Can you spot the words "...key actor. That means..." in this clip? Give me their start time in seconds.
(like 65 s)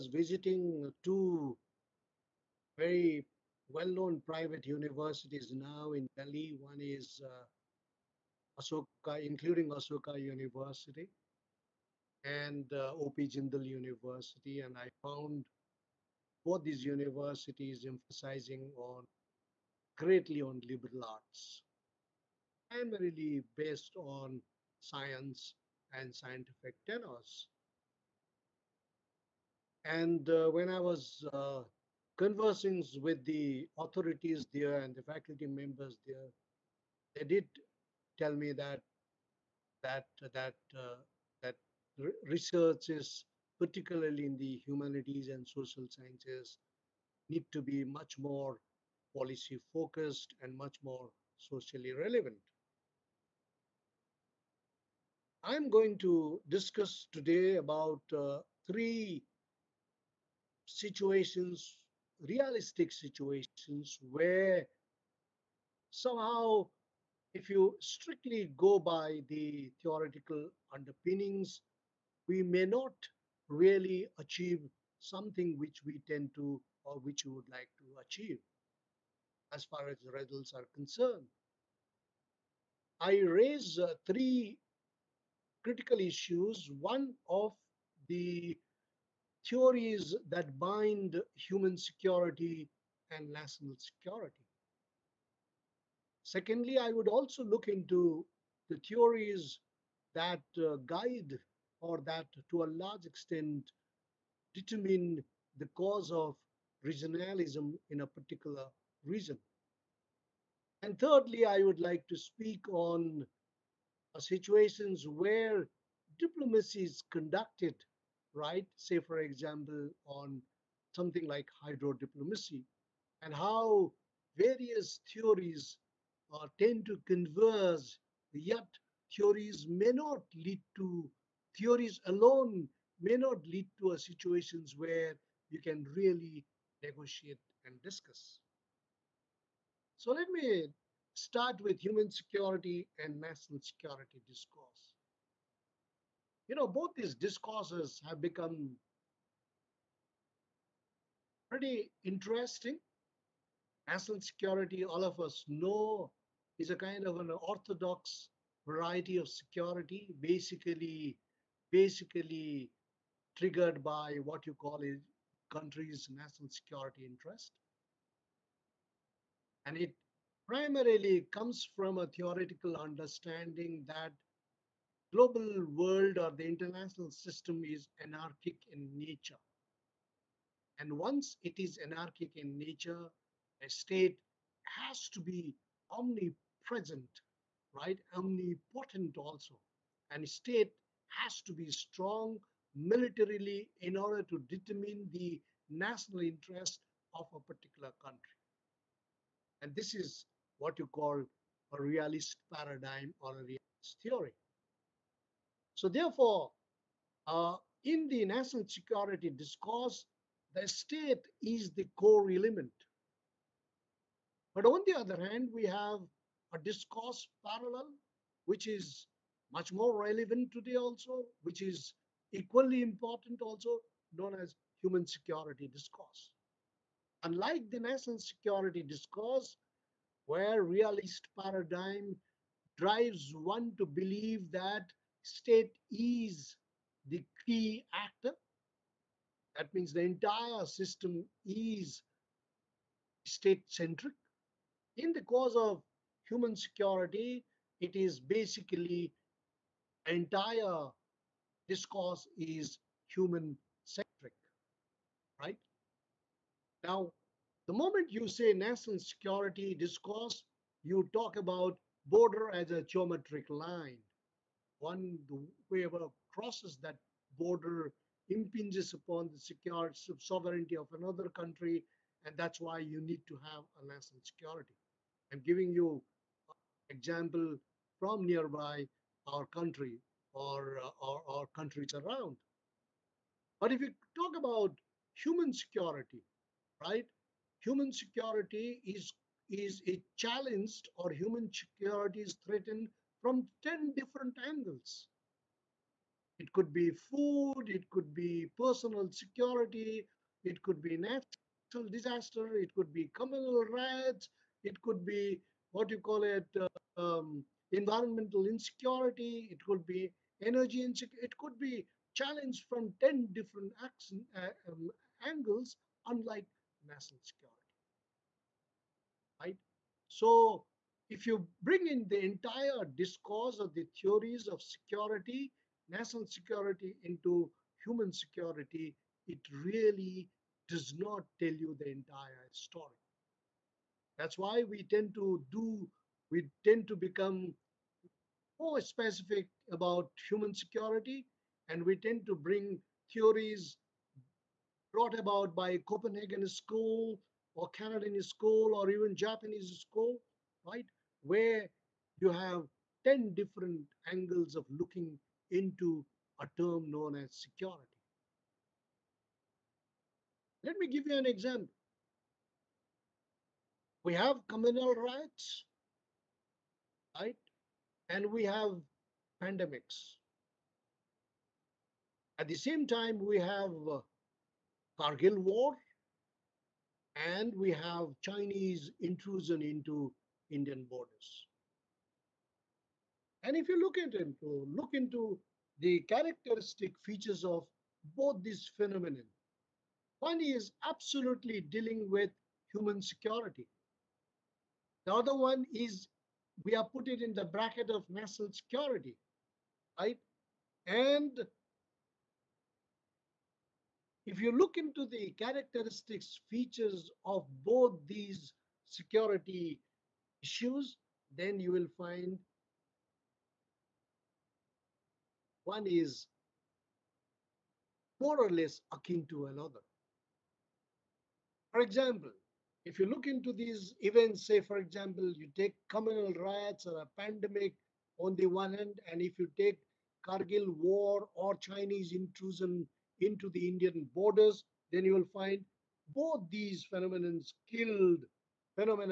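237 s.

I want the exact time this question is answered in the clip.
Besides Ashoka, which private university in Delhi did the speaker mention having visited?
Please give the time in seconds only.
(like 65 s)
12 s.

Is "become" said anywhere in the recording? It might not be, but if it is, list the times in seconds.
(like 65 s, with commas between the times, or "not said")
148 s, 336 s.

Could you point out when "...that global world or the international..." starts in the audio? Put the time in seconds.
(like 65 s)
173 s.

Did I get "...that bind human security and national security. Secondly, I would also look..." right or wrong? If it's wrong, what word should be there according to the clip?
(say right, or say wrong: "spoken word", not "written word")
right.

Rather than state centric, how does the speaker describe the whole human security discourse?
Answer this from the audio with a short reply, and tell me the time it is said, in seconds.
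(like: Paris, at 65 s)
human centric, at 253 s.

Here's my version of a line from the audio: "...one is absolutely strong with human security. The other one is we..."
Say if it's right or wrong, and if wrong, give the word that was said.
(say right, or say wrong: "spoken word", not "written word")
wrong: "dealing", not "strong".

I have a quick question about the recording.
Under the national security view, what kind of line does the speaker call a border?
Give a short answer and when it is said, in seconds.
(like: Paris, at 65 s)
geometric line, at 262 s.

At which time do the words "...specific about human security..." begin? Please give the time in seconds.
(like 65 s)
338 s.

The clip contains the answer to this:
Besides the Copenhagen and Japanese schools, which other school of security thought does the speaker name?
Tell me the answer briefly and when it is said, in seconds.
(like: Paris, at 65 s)
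Canadian School, at 347 s.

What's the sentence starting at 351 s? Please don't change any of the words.
Where you have 10 different angles of looking into a term known as security.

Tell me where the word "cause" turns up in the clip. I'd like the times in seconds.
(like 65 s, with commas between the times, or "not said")
105 s, 245 s.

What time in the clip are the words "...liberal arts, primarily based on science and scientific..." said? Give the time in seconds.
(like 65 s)
20 s.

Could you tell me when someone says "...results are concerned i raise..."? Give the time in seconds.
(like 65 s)
80 s.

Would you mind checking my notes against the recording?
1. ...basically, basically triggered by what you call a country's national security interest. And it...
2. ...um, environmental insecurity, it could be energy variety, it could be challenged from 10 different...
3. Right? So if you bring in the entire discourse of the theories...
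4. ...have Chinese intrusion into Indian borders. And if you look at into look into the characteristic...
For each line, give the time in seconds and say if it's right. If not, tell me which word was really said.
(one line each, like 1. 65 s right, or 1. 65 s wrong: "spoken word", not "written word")
1. 160 s right
2. 307 s wrong: "insecurity", not "variety"
3. 319 s right
4. 377 s right.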